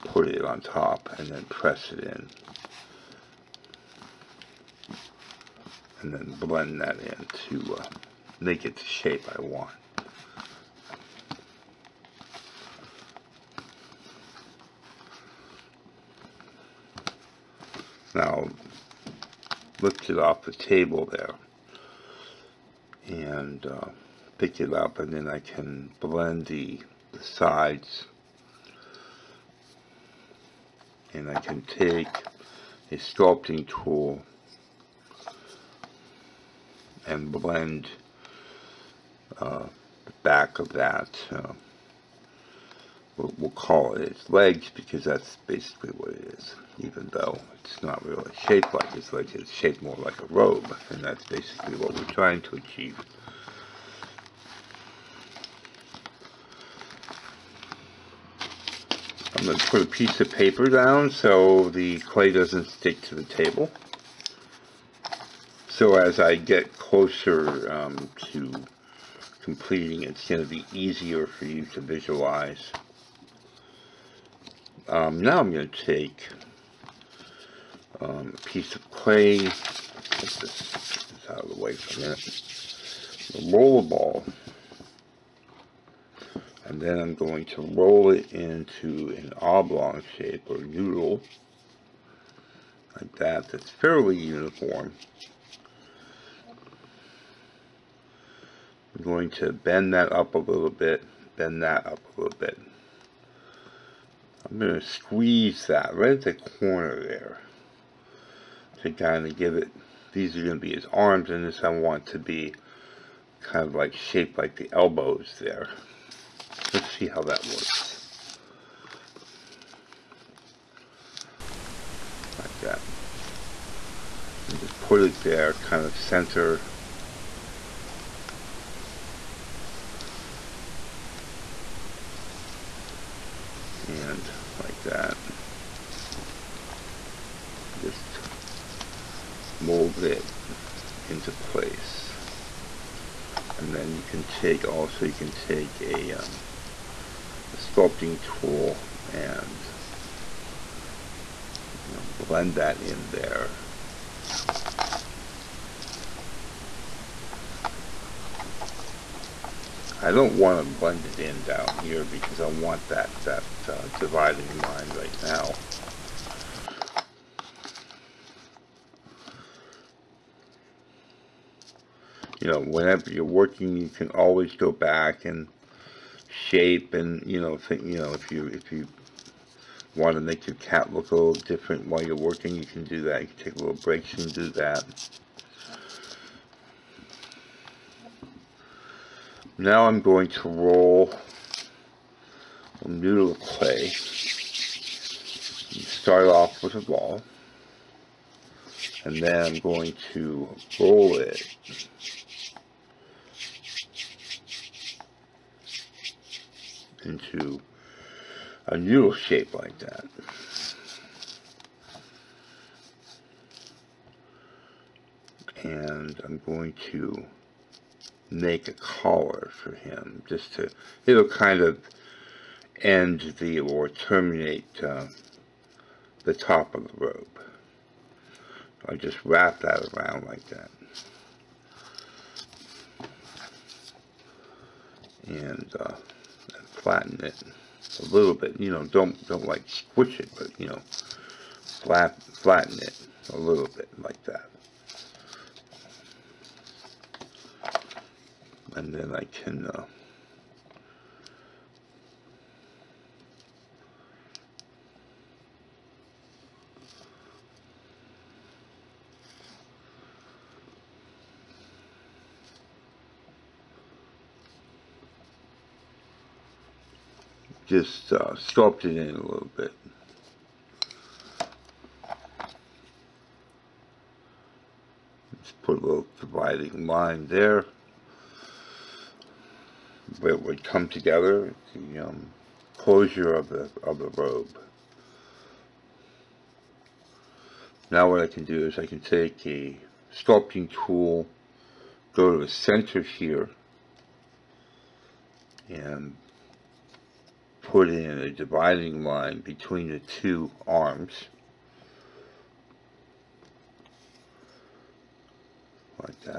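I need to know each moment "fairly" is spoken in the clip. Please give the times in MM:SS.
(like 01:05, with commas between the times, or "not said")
01:33.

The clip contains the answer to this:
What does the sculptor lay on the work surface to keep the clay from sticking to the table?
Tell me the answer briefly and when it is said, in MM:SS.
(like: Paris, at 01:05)
A piece of paper, at 00:59.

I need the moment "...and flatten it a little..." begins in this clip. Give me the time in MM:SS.
03:56.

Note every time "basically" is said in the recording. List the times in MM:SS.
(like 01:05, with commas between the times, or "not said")
00:45, 00:51.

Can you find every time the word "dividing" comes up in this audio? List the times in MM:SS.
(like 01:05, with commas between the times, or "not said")
02:43, 04:36, 04:58.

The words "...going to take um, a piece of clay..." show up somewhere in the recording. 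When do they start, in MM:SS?
01:15.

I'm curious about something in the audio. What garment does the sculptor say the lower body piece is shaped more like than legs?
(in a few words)
A robe.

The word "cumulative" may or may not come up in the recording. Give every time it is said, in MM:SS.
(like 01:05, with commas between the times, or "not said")
not said.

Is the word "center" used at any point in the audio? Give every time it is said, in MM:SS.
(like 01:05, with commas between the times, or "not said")
02:05, 04:52.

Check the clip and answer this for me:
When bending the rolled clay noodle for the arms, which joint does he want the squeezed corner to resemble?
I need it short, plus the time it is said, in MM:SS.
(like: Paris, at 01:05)
Elbows, at 01:54.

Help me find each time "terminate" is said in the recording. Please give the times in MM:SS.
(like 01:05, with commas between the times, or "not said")
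03:43.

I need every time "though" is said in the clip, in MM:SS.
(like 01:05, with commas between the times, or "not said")
00:47.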